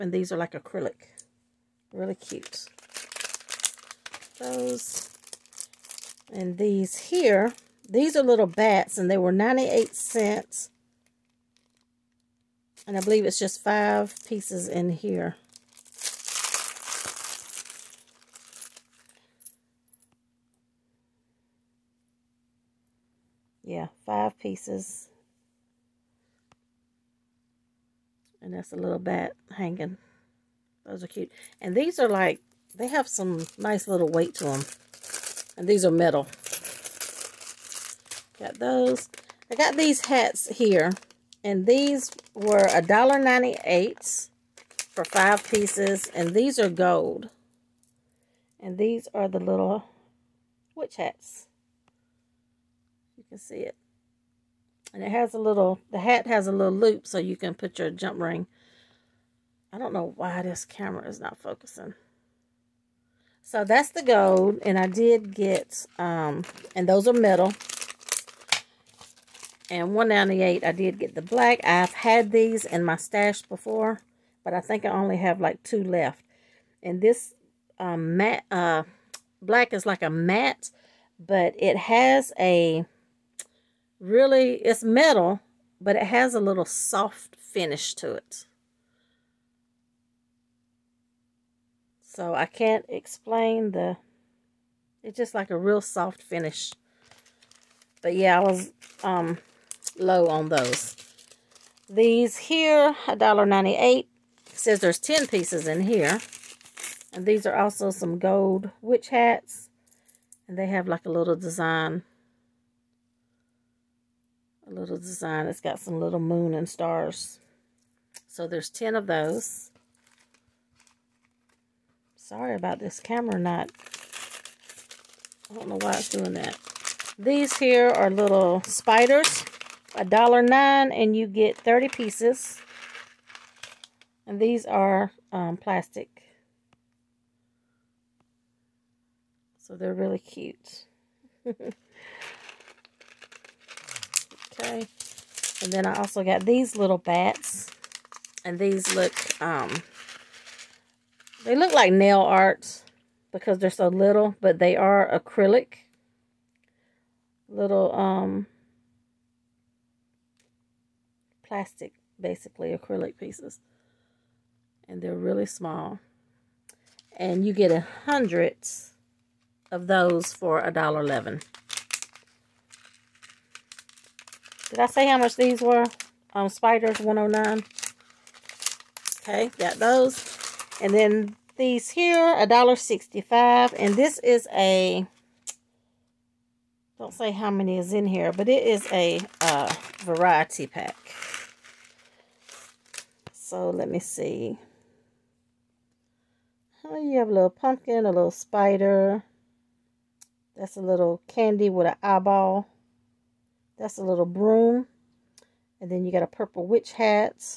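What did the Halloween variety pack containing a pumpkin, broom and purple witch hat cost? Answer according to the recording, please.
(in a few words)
$1.65.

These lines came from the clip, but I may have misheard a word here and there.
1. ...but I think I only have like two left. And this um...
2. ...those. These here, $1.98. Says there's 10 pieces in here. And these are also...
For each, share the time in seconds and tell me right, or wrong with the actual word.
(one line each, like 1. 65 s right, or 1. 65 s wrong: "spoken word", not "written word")
1. 74 s right
2. 100 s right.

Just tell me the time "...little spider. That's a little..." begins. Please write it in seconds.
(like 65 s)
198 s.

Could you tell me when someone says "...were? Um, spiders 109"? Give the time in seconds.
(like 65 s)
175 s.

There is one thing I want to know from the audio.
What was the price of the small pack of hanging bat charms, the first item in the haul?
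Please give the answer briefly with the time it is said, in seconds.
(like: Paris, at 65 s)
98 cents, at 9 s.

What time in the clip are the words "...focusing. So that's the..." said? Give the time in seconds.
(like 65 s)
61 s.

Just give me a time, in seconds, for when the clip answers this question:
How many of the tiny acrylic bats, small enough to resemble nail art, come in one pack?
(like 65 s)
167 s.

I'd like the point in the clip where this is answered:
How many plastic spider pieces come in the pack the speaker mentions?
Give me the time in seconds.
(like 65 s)
131 s.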